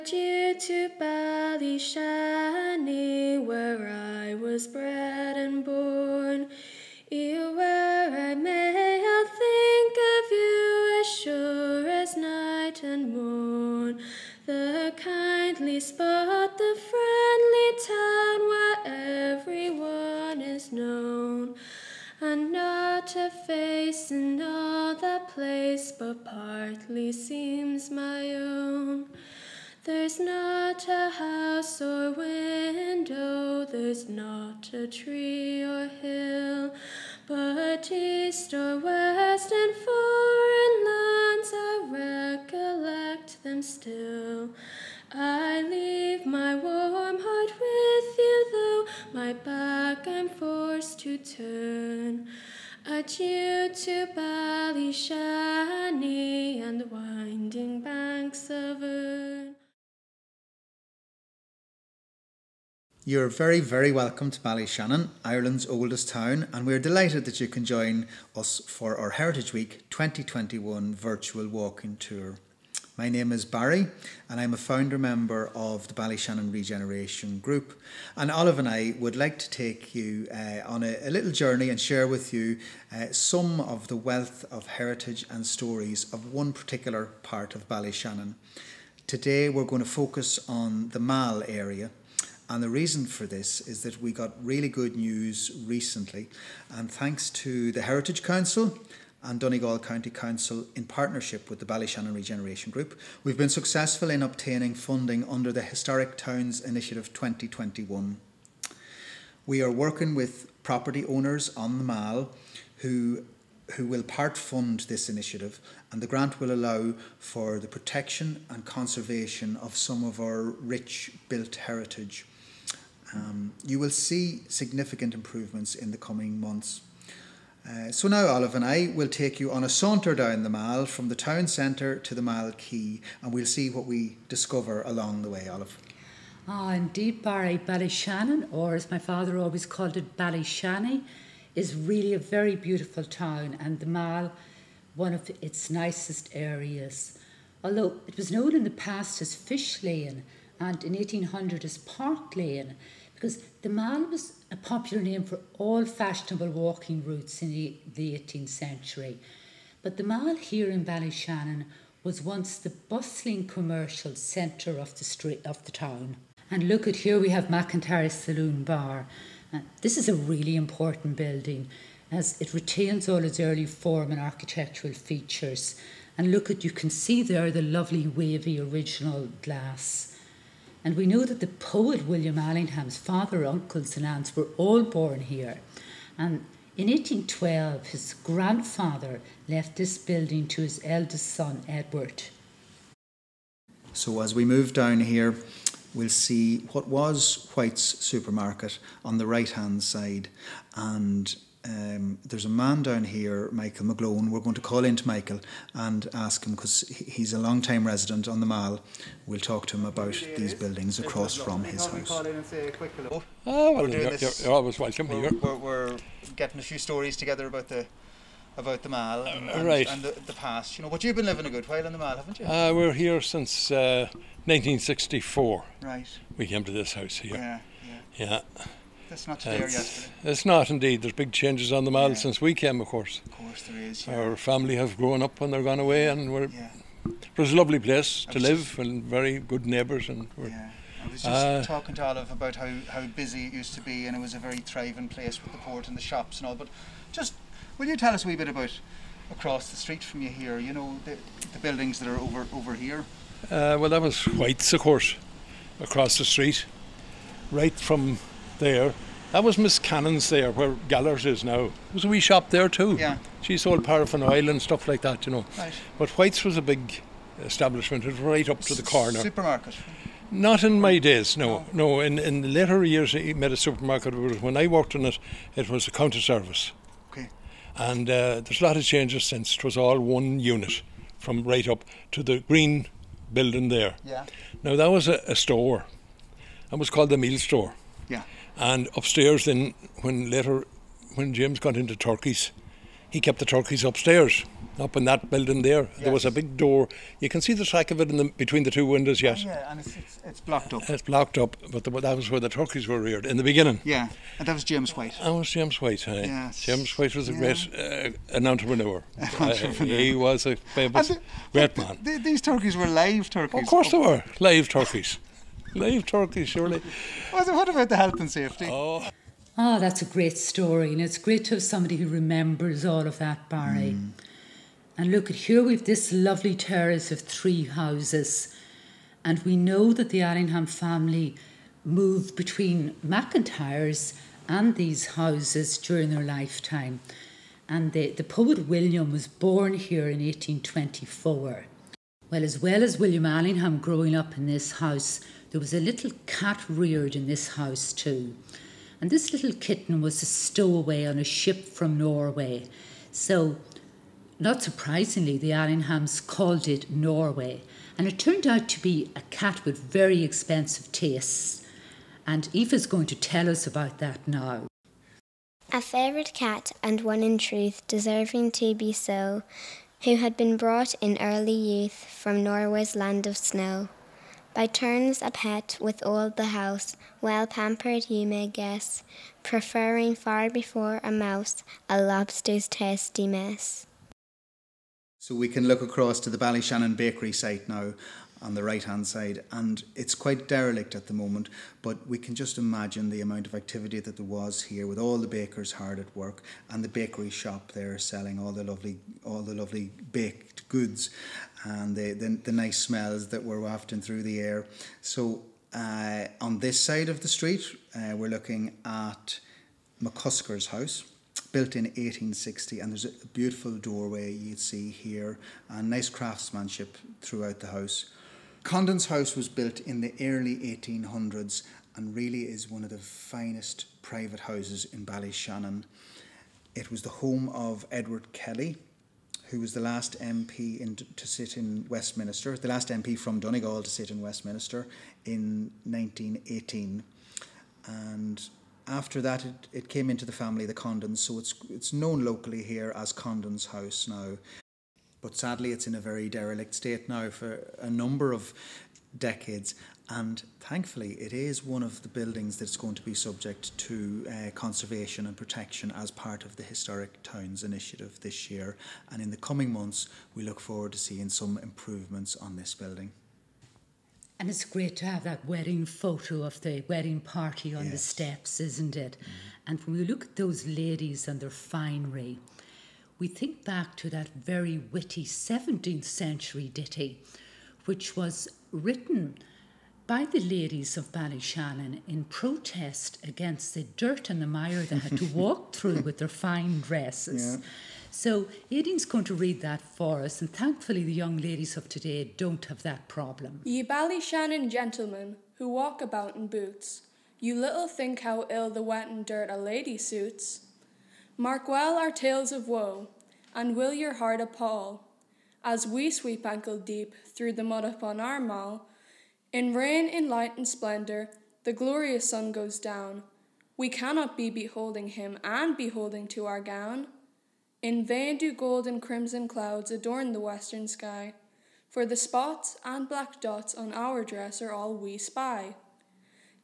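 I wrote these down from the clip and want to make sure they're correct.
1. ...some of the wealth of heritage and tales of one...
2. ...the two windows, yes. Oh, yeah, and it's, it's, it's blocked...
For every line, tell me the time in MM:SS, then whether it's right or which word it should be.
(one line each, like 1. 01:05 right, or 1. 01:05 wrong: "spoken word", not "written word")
1. 01:23 wrong: "stories", not "tales"
2. 04:58 right.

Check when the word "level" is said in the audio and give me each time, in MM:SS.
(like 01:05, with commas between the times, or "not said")
not said.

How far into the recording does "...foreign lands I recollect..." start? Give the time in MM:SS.
00:39.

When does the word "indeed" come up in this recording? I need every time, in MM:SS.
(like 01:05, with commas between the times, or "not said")
02:16, 03:50.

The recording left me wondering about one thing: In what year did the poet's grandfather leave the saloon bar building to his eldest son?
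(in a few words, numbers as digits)
1812.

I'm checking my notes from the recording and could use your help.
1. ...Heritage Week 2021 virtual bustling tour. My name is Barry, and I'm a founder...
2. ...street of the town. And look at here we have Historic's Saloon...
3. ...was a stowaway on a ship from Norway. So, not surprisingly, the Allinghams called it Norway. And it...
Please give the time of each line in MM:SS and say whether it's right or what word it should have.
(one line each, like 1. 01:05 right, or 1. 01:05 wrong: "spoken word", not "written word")
1. 01:09 wrong: "walking", not "bustling"
2. 02:45 wrong: "McIntyre", not "Historic"
3. 05:50 right.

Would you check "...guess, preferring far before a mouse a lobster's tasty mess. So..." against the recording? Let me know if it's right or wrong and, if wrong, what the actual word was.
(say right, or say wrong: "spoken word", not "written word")
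right.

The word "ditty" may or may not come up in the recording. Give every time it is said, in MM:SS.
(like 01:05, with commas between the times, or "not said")
07:56.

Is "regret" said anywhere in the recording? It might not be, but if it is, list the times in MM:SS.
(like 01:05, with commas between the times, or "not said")
not said.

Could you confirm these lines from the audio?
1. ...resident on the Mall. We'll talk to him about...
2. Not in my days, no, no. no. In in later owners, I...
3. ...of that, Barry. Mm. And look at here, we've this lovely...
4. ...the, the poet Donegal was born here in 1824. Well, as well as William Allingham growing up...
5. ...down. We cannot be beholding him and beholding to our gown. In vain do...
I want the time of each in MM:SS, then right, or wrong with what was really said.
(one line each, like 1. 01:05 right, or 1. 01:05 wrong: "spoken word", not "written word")
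1. 03:27 right
2. 04:30 wrong: "years", not "owners"
3. 05:23 right
4. 05:37 wrong: "William", not "Donegal"
5. 08:32 right.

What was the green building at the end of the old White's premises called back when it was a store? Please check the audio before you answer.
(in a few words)
The meal store.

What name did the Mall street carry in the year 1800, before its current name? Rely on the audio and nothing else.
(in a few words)
Park Lane.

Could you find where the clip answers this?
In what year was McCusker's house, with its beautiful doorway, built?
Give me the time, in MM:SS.
06:51.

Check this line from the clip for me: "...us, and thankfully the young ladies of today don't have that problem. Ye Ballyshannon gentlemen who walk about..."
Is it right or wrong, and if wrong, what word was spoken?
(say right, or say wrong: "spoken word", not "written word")
right.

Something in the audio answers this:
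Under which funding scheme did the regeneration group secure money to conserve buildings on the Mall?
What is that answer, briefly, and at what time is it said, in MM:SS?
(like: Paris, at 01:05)
Historic Towns Initiative 2021, at 01:45.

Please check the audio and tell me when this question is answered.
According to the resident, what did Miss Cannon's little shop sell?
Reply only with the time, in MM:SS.
04:23.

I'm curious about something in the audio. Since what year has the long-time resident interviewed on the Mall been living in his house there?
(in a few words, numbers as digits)
1964.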